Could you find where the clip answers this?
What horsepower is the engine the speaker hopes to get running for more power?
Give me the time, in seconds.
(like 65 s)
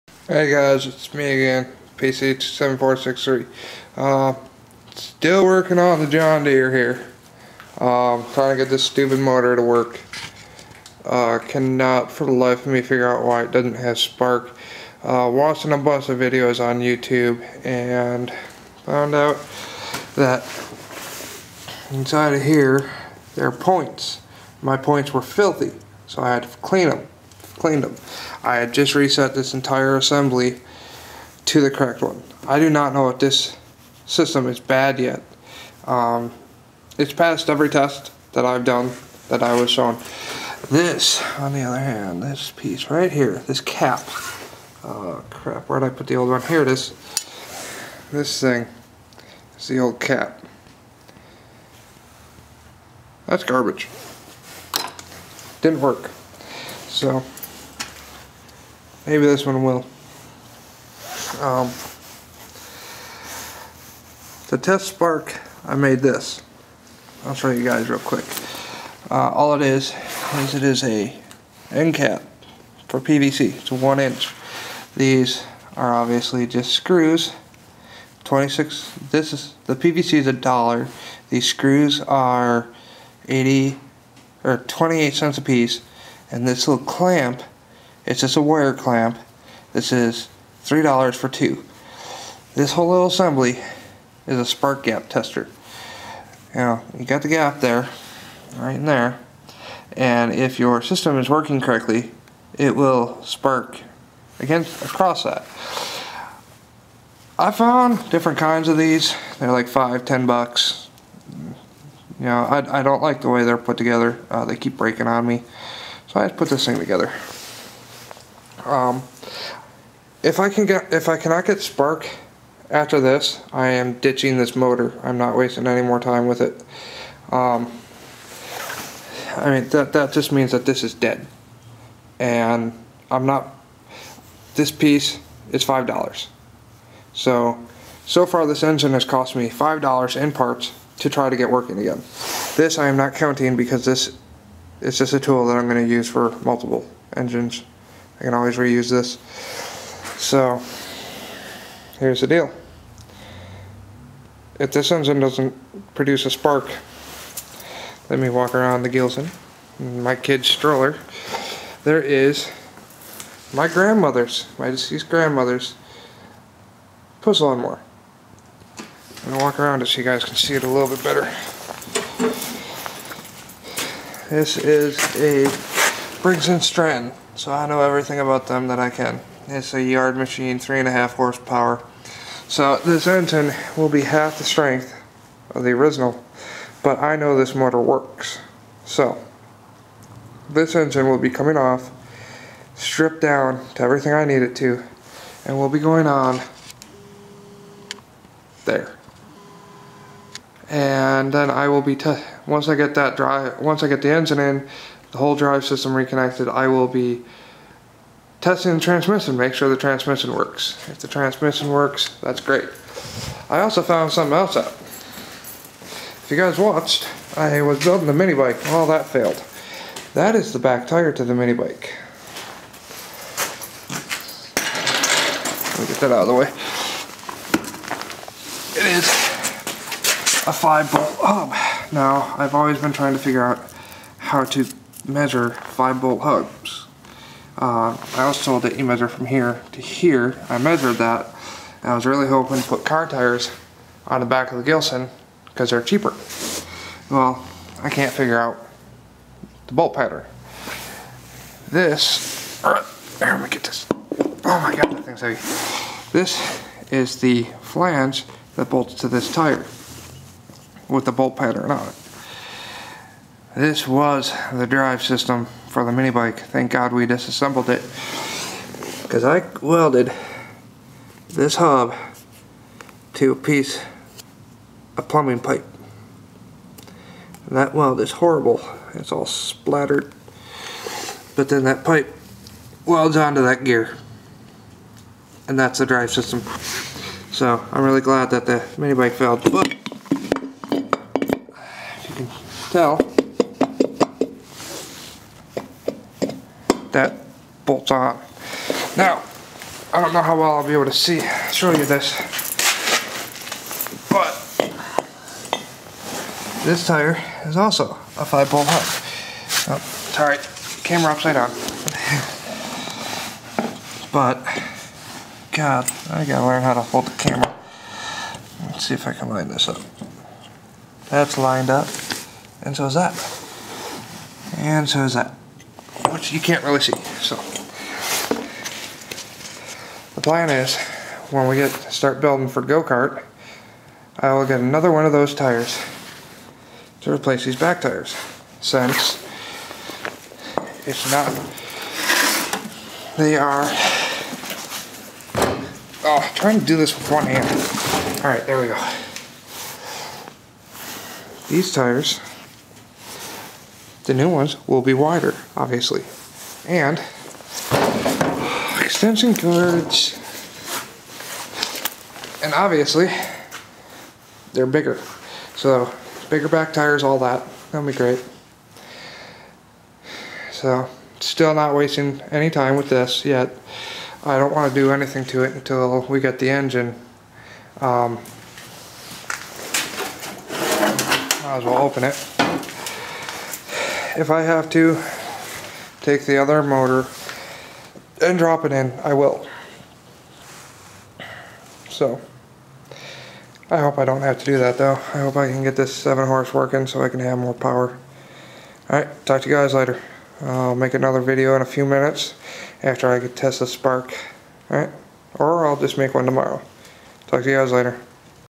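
395 s.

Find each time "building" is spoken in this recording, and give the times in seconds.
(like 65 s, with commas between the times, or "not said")
217 s, 332 s.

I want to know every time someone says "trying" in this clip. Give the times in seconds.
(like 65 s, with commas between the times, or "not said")
8 s, 232 s, 346 s.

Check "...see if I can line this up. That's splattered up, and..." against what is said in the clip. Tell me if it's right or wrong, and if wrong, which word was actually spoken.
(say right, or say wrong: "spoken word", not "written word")
wrong: "lined", not "splattered".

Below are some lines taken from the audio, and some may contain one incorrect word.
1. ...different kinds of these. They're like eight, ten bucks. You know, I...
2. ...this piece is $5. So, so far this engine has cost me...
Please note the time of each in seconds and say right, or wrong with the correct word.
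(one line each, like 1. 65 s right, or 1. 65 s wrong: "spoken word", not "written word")
1. 108 s wrong: "five", not "eight"
2. 134 s right.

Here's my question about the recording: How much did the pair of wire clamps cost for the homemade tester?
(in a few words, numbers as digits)
$3.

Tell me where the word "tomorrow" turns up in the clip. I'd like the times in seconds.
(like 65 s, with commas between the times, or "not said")
406 s.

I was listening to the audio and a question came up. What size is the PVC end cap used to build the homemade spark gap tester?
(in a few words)
1 inch.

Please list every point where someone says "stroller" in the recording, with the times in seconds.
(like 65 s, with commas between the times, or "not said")
160 s.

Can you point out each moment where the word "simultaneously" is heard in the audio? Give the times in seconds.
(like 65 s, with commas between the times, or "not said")
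not said.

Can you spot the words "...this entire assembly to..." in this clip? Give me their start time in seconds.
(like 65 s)
29 s.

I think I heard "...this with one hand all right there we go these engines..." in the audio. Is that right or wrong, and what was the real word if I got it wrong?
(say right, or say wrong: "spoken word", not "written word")
wrong: "tires", not "engines".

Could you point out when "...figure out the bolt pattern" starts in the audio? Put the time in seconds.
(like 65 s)
248 s.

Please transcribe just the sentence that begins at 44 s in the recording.
Oh crap, where did I put the old one?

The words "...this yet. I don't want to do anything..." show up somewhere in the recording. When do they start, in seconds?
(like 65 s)
372 s.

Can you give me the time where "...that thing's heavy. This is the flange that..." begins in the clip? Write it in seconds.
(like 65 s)
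254 s.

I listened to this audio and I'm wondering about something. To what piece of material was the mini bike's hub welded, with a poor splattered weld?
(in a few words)
plumbing pipe.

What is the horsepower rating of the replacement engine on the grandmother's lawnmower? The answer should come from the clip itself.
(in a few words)
3.5 horsepower.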